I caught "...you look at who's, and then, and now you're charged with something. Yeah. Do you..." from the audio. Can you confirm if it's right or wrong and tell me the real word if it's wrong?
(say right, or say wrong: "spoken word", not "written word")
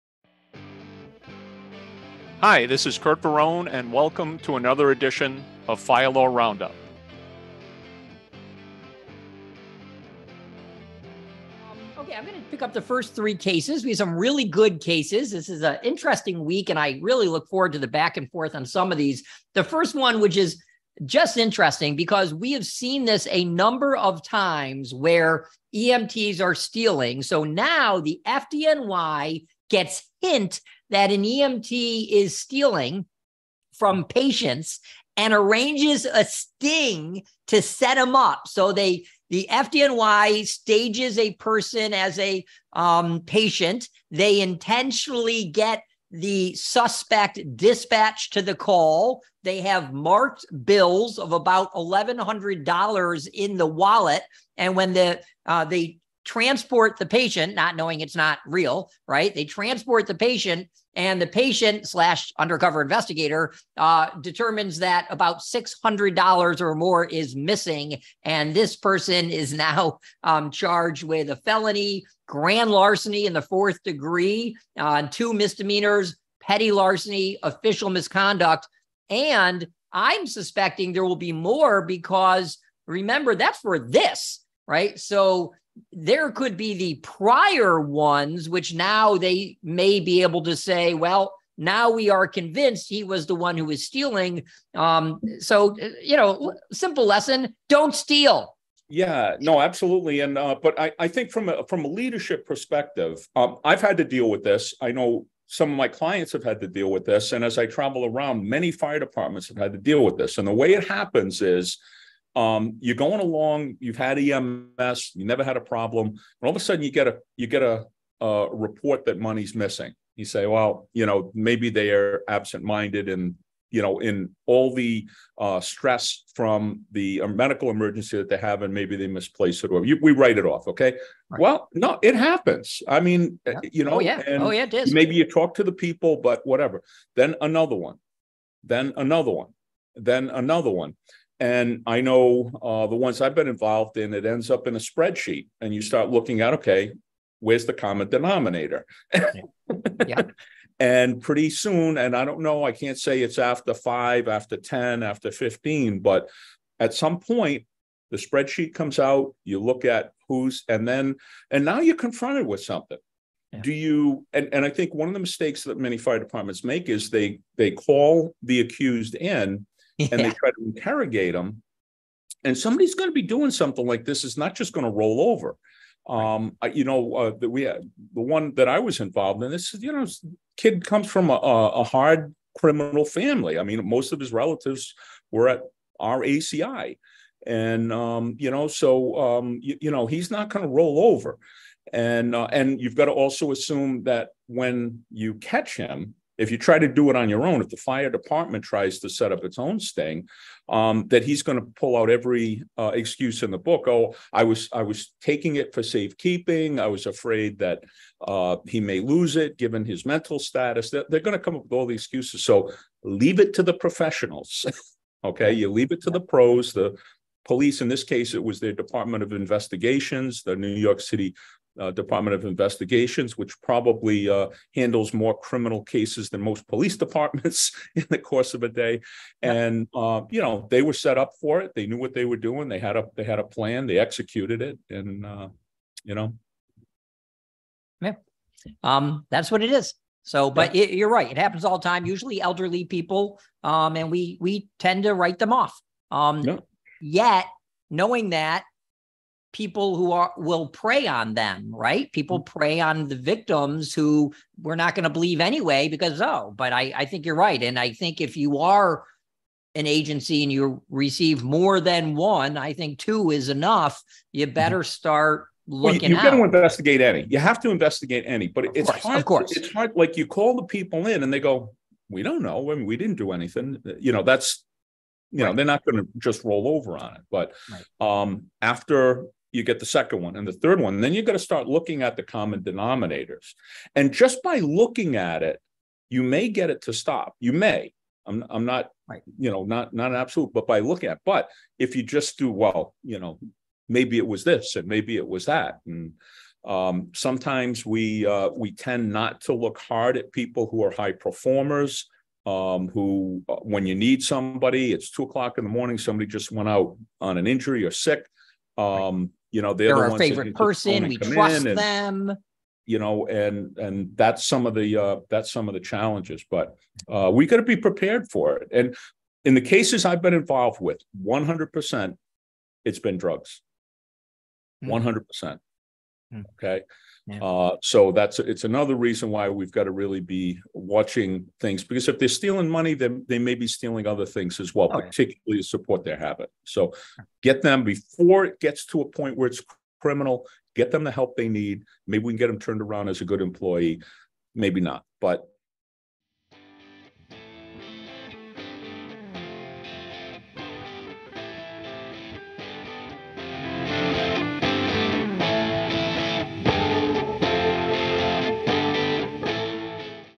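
wrong: "confronted", not "charged".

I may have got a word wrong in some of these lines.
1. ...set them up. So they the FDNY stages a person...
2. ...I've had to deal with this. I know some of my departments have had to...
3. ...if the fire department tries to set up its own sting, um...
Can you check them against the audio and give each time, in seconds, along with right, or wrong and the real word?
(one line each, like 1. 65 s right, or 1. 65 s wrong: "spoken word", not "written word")
1. 37 s right
2. 103 s wrong: "clients", not "departments"
3. 197 s right.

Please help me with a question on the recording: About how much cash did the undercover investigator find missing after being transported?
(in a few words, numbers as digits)
$600.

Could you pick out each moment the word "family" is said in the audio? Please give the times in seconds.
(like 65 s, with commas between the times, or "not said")
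183 s.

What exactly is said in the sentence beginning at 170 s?
and they try to interrogate them.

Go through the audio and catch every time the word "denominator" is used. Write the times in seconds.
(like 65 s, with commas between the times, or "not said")
148 s, 282 s.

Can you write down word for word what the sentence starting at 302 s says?
Um, who, uh, when you need somebody, it's two o'clock in the morning.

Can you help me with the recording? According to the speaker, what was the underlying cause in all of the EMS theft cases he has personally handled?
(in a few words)
Drugs.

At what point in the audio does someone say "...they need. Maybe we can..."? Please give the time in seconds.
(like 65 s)
341 s.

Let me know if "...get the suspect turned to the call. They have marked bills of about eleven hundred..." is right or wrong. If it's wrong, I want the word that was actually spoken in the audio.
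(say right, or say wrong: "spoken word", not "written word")
wrong: "dispatched", not "turned".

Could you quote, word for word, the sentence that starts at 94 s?
Um, so, you know, simple lesson don't steal.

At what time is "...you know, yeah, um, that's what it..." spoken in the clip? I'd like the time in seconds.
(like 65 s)
236 s.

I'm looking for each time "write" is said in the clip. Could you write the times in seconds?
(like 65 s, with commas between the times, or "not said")
130 s, 245 s.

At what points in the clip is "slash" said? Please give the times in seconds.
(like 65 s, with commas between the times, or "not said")
61 s.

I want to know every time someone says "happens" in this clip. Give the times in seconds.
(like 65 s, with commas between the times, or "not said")
110 s, 132 s, 241 s.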